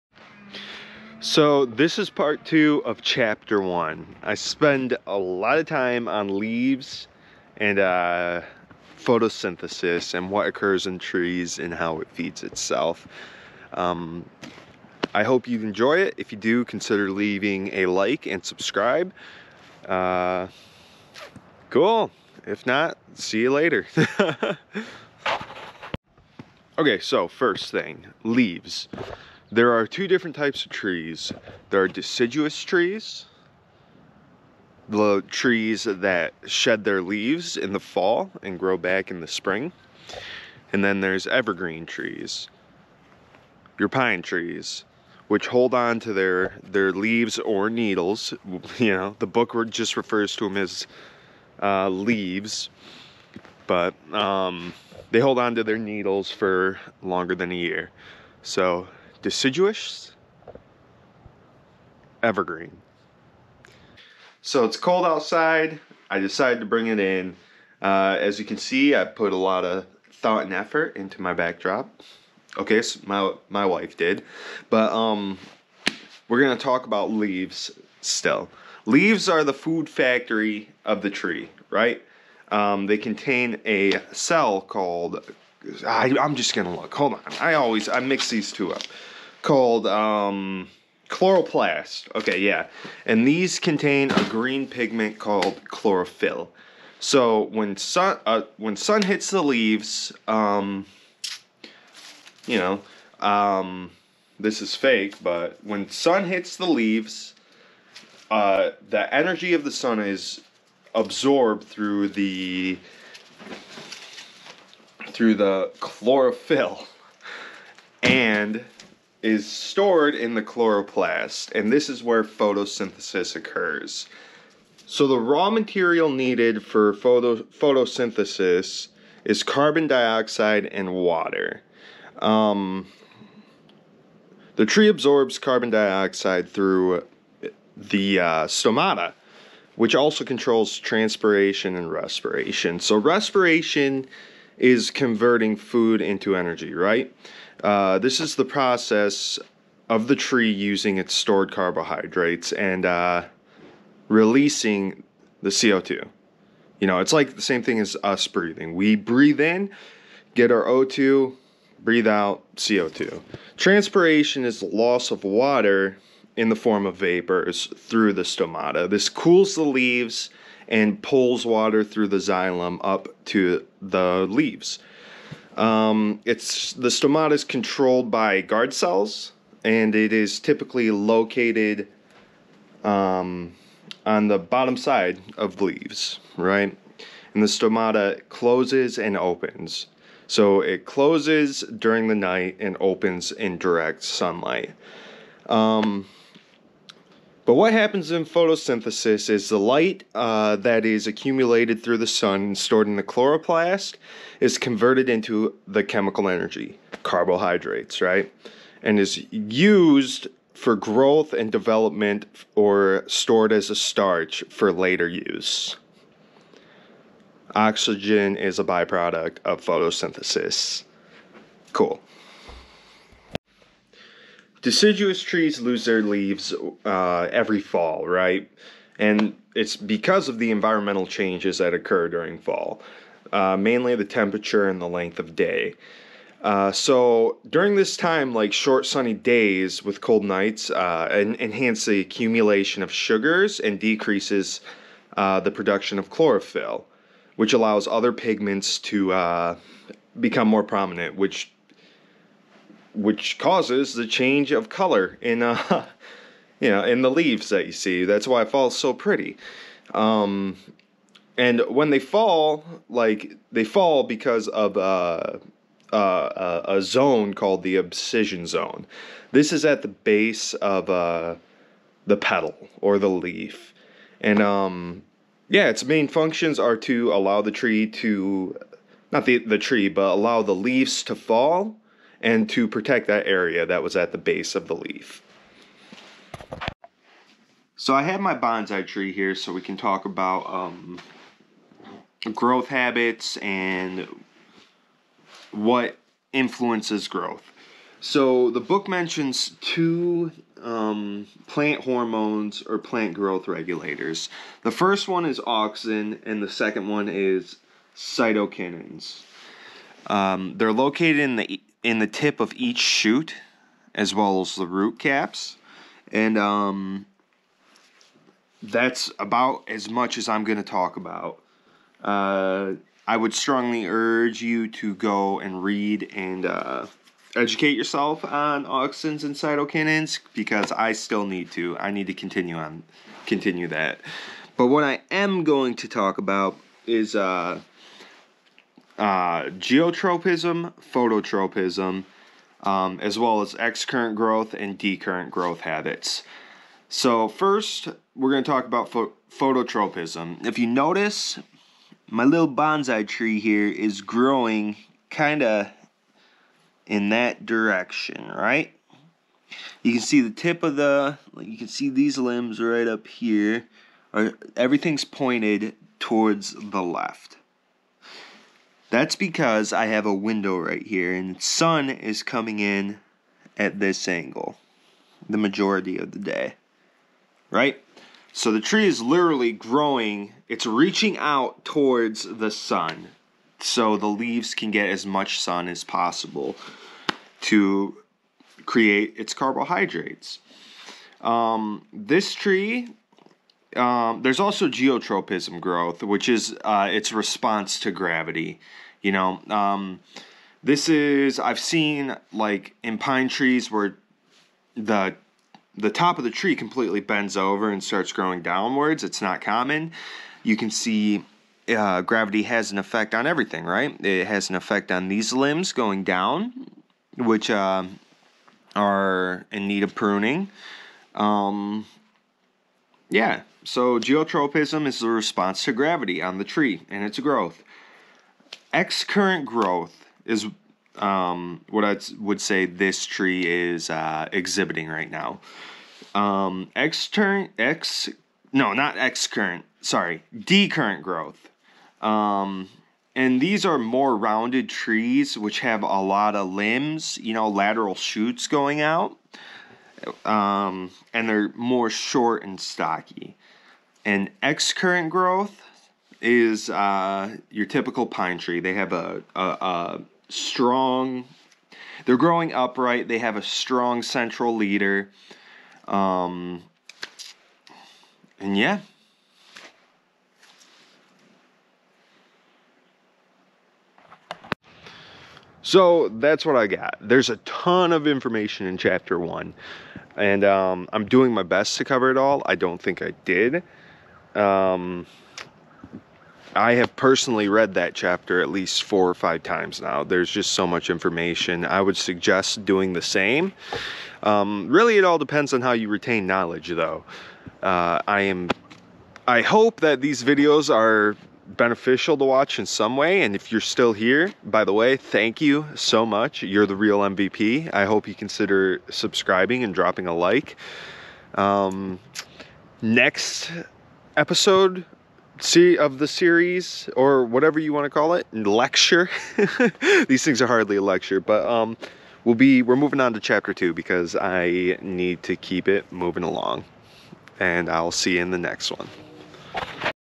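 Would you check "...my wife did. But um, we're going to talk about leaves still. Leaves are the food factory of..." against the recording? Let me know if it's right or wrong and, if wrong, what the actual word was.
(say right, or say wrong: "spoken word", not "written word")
right.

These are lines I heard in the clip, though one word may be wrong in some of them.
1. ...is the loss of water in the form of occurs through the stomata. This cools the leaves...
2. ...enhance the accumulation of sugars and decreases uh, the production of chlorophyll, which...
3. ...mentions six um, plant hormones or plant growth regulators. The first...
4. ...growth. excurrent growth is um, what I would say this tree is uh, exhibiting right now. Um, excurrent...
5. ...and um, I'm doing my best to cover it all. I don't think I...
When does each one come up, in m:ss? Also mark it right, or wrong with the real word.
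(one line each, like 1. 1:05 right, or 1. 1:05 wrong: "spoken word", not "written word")
1. 2:44 wrong: "vapors", not "occurs"
2. 4:01 right
3. 4:58 wrong: "two", not "six"
4. 7:07 right
5. 8:00 right.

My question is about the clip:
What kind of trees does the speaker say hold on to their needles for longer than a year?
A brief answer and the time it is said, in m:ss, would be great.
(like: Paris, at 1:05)
evergreen trees, at 0:41.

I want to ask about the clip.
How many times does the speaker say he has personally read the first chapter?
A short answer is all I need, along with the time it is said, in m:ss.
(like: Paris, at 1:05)
4 or 5, at 8:08.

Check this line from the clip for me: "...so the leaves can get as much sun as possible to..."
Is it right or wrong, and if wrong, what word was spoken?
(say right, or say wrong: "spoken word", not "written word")
right.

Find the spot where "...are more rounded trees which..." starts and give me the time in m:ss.
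7:23.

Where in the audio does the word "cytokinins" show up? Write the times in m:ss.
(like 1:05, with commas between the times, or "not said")
5:07, 5:29.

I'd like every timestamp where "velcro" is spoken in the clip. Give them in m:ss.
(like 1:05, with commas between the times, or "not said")
not said.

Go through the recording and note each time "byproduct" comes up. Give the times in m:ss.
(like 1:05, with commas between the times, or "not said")
3:38.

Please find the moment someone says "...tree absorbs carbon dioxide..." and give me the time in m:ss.
2:14.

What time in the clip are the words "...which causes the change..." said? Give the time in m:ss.
4:12.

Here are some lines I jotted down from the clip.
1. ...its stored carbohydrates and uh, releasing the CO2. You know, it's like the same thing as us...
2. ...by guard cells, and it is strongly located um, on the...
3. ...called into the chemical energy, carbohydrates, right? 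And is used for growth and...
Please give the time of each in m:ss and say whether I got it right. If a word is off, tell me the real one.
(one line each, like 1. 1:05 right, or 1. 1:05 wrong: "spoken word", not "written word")
1. 2:30 right
2. 2:58 wrong: "typically", not "strongly"
3. 3:24 wrong: "converted", not "called".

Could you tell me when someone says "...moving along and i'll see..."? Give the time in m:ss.
8:45.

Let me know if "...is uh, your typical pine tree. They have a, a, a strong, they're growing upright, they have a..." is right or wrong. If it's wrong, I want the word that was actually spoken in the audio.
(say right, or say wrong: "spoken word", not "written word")
right.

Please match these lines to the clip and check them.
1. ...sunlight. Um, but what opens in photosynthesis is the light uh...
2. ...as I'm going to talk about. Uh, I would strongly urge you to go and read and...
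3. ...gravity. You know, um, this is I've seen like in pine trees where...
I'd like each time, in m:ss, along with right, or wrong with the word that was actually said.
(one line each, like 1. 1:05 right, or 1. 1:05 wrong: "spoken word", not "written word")
1. 3:14 wrong: "happens", not "opens"
2. 5:20 right
3. 6:37 right.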